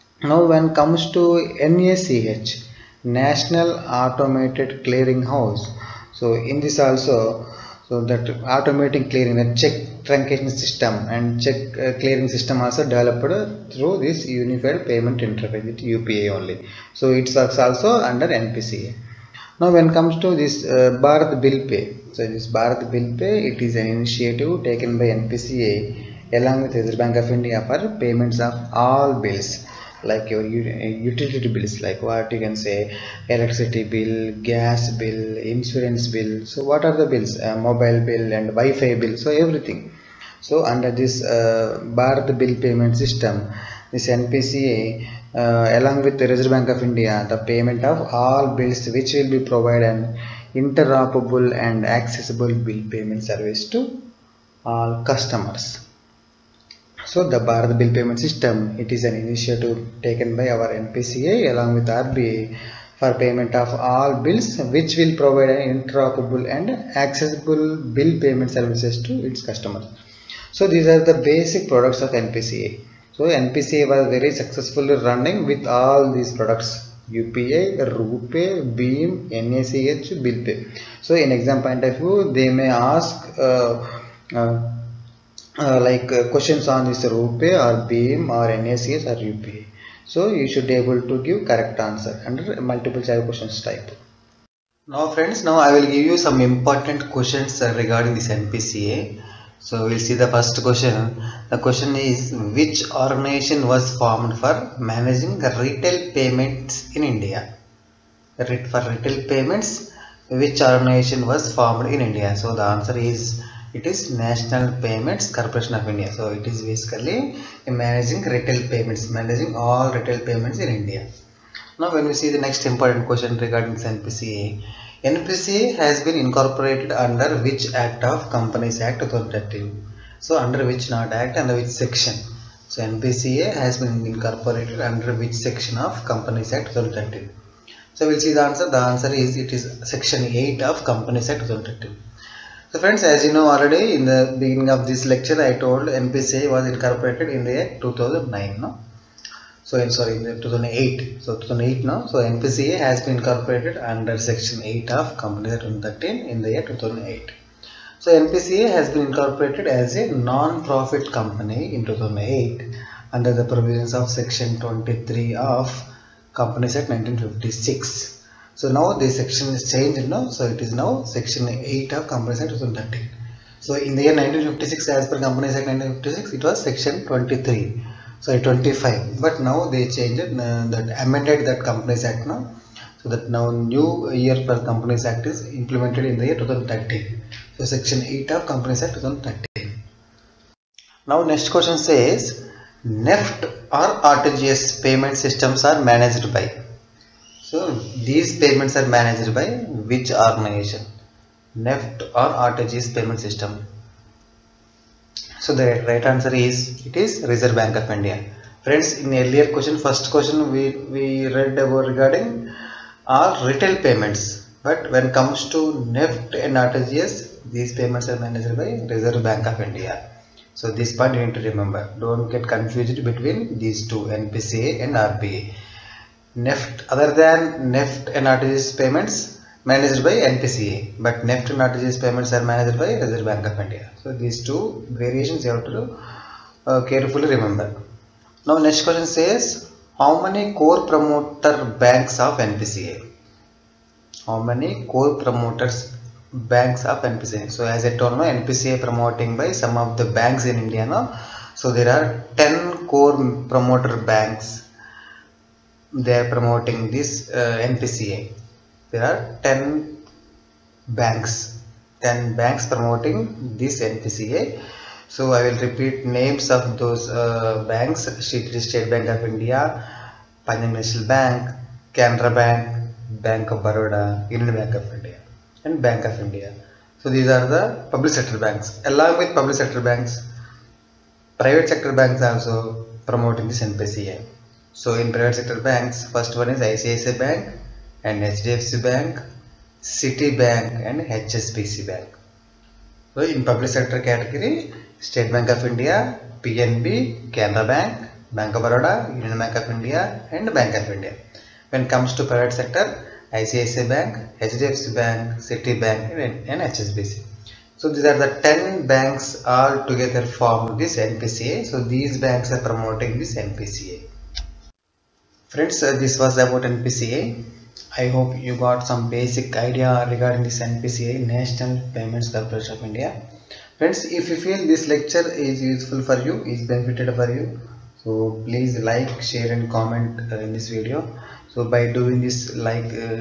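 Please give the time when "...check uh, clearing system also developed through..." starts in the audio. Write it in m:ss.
0:11.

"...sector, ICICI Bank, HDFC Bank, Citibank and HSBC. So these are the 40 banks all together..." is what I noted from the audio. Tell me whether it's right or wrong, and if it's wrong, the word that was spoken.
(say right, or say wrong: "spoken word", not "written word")
wrong: "10", not "40".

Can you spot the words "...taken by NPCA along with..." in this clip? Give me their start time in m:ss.
0:24.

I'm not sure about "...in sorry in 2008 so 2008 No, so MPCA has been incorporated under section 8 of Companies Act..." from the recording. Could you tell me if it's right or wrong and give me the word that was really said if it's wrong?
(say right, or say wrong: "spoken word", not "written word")
right.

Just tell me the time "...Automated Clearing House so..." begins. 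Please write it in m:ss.
0:04.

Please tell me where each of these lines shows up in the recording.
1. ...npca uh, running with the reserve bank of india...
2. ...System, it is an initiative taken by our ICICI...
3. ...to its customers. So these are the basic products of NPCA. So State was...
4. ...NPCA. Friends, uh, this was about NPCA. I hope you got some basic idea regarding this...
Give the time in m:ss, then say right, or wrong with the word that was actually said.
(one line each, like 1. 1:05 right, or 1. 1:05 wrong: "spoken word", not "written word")
1. 0:44 wrong: "along", not "running"
2. 0:58 wrong: "NPCA", not "ICICI"
3. 1:09 wrong: "NPCA", not "State"
4. 5:13 right.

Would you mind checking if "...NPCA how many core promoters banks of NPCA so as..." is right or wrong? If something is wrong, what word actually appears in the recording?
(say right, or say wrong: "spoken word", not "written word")
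right.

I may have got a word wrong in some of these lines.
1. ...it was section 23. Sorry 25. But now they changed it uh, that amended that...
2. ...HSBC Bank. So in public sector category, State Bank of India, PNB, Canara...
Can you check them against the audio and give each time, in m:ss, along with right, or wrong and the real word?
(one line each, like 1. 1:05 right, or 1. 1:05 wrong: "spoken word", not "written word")
1. 2:56 right
2. 4:50 right.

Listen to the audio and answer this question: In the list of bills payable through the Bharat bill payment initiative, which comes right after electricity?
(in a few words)
gas bill.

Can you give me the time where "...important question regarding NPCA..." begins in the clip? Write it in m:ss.
2:02.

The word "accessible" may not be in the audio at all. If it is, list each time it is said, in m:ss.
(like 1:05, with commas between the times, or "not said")
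0:51, 1:06.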